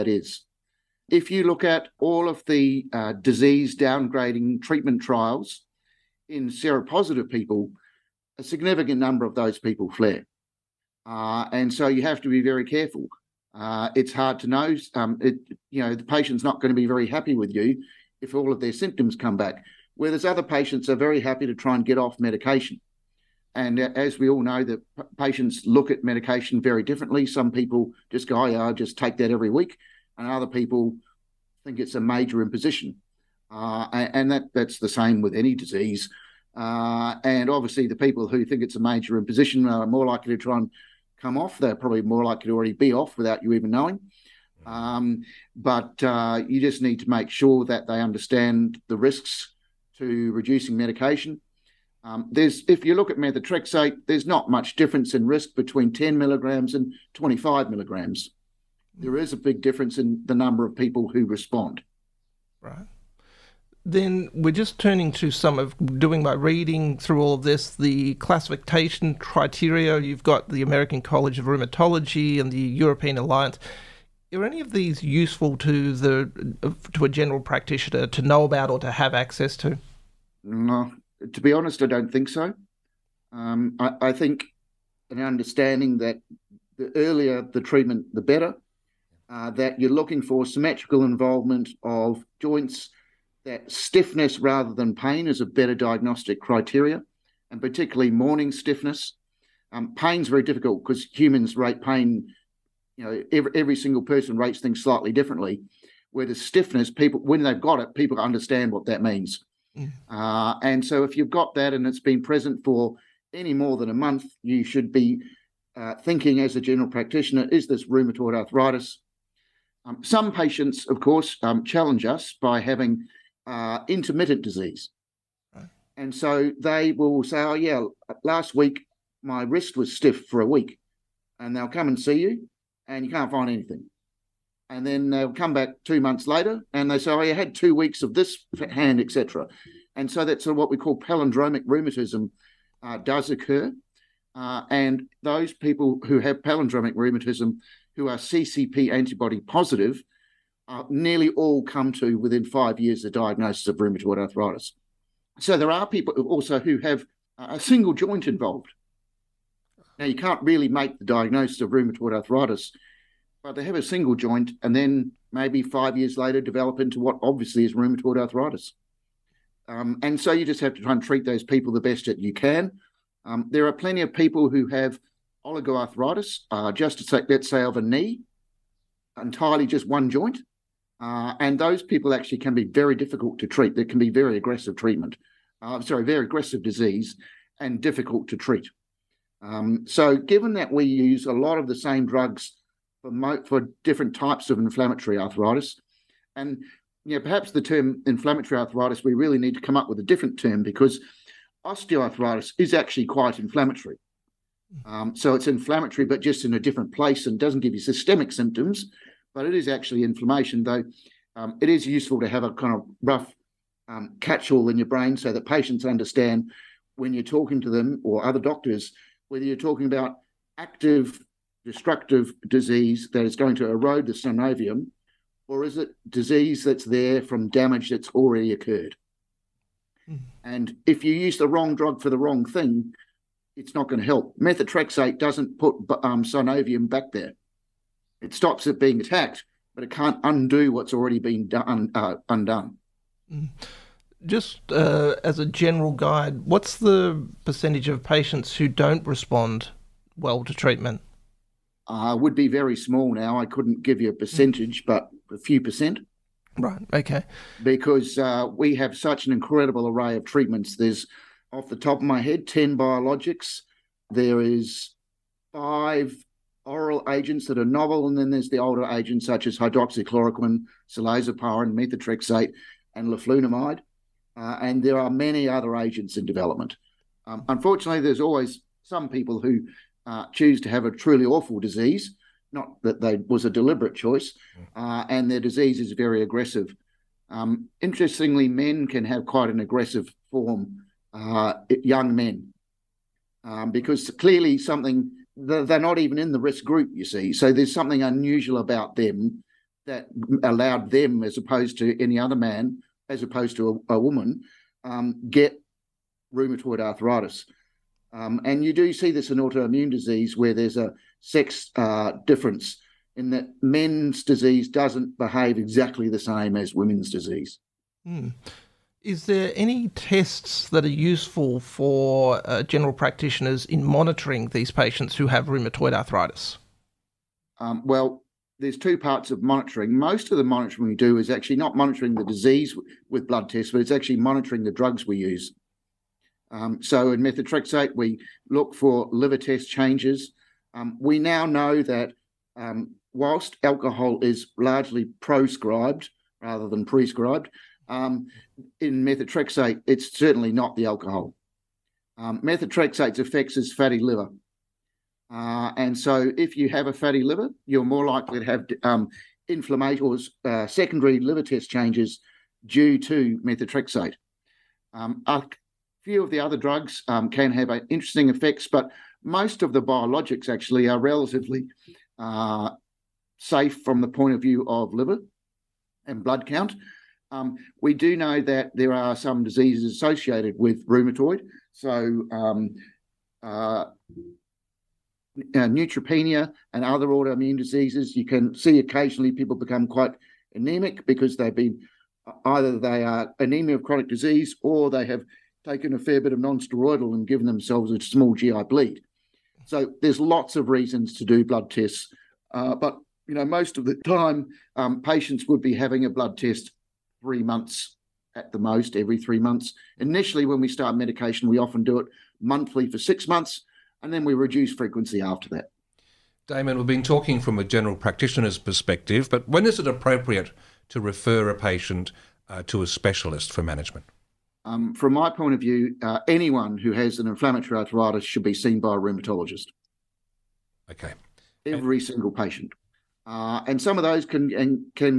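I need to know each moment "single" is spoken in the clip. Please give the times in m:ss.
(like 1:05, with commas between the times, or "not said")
1:43, 2:37, 2:43, 7:12.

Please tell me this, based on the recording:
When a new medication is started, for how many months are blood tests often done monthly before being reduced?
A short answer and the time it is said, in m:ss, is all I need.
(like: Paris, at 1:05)
6, at 6:52.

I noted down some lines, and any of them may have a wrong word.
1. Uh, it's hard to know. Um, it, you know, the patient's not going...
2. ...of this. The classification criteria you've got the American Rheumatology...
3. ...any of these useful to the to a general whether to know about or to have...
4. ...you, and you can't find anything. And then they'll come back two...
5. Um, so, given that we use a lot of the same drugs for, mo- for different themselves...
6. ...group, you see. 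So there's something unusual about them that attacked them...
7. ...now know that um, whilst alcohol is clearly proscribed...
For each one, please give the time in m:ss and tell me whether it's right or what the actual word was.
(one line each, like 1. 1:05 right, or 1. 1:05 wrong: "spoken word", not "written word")
1. 0:13 right
2. 1:07 wrong: "College", not "Rheumatology"
3. 1:14 wrong: "practitioner", not "whether"
4. 2:12 right
5. 3:09 wrong: "types", not "themselves"
6. 4:56 wrong: "allowed", not "attacked"
7. 5:41 wrong: "largely", not "clearly".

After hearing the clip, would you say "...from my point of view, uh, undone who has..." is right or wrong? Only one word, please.
wrong.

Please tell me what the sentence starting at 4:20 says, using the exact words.
There's off the top of my head, 10 biologics.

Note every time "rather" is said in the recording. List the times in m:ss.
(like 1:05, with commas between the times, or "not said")
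1:34, 5:46.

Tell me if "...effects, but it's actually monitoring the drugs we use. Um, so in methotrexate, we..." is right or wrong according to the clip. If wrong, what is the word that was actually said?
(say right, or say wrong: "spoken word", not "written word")
wrong: "tests", not "effects".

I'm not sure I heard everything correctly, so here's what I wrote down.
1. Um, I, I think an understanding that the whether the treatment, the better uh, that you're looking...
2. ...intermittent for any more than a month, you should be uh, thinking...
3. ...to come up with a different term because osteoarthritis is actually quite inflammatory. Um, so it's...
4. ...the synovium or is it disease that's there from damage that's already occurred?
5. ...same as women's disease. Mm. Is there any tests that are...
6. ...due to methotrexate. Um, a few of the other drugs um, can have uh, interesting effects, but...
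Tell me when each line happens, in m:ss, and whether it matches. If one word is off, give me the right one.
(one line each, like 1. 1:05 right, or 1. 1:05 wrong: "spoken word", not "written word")
1. 1:23 wrong: "earlier", not "whether"
2. 1:52 wrong: "present", not "intermittent"
3. 3:19 right
4. 3:44 right
5. 5:16 right
6. 6:02 right.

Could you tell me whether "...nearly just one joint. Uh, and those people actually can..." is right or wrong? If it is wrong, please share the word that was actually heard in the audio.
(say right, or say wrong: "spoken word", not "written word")
wrong: "entirely", not "nearly".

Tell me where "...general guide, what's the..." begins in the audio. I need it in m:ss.
4:05.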